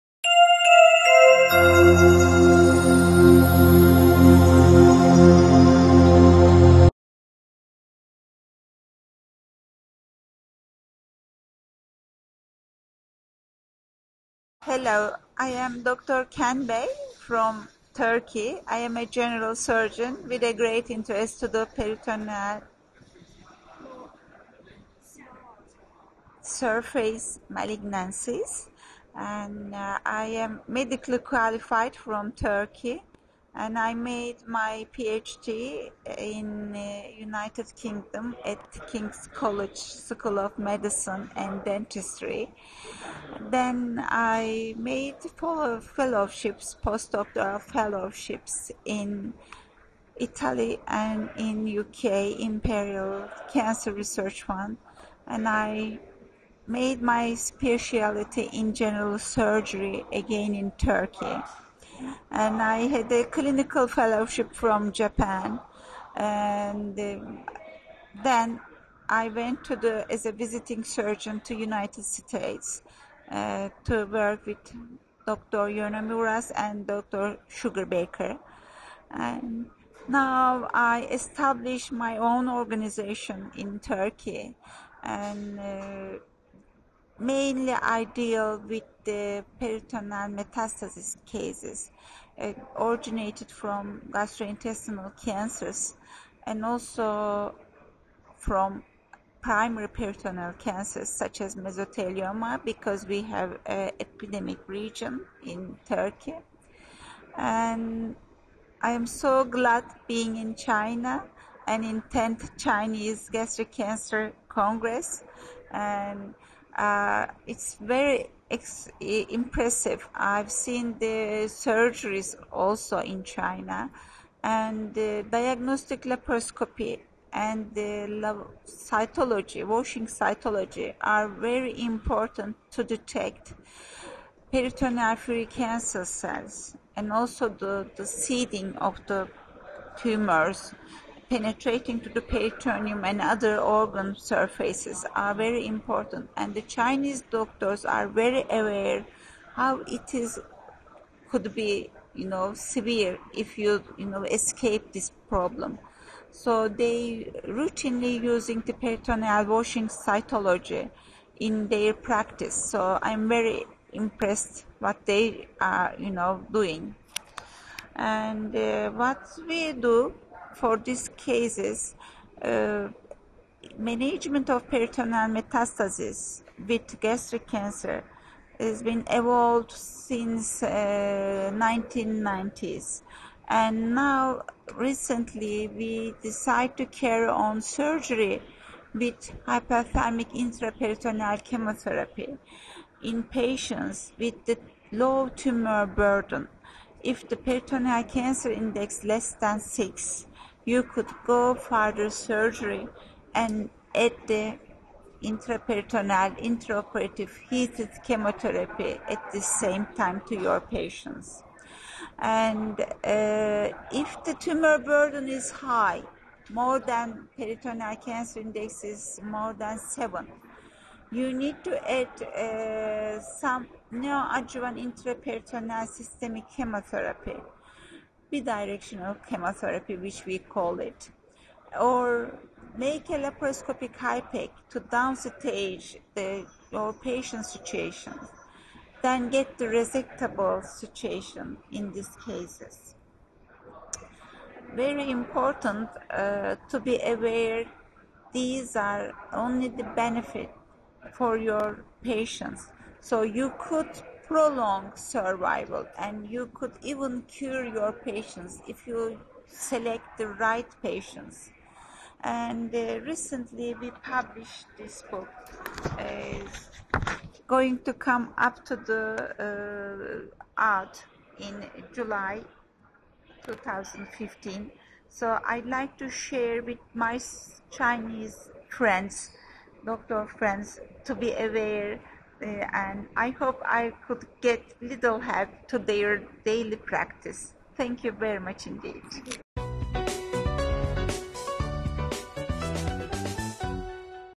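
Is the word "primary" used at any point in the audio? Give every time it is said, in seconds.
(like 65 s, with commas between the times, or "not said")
99 s.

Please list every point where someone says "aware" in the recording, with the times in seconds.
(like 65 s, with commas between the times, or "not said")
148 s, 247 s, 281 s.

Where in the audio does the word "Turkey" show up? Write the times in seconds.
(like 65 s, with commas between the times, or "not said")
17 s, 32 s, 60 s, 83 s, 105 s.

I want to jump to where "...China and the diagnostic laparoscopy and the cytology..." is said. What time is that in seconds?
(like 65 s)
123 s.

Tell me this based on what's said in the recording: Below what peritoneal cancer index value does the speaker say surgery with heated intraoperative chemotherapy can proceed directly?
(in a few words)
6.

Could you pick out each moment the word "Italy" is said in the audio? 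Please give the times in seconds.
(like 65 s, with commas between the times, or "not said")
50 s.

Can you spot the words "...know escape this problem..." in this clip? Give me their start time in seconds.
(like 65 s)
154 s.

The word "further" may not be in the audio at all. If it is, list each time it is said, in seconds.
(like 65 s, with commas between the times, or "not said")
201 s.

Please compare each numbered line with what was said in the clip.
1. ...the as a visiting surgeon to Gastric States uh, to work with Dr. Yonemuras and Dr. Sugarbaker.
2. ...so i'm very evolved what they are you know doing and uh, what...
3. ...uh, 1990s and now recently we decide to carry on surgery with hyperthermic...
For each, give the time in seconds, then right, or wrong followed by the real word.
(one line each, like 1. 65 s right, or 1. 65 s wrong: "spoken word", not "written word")
1. 69 s wrong: "United", not "Gastric"
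2. 162 s wrong: "impressed", not "evolved"
3. 180 s right.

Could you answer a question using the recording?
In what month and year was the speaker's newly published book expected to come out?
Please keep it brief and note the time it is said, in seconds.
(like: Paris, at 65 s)
July 2015, at 271 s.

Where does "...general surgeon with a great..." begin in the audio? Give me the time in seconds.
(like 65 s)
19 s.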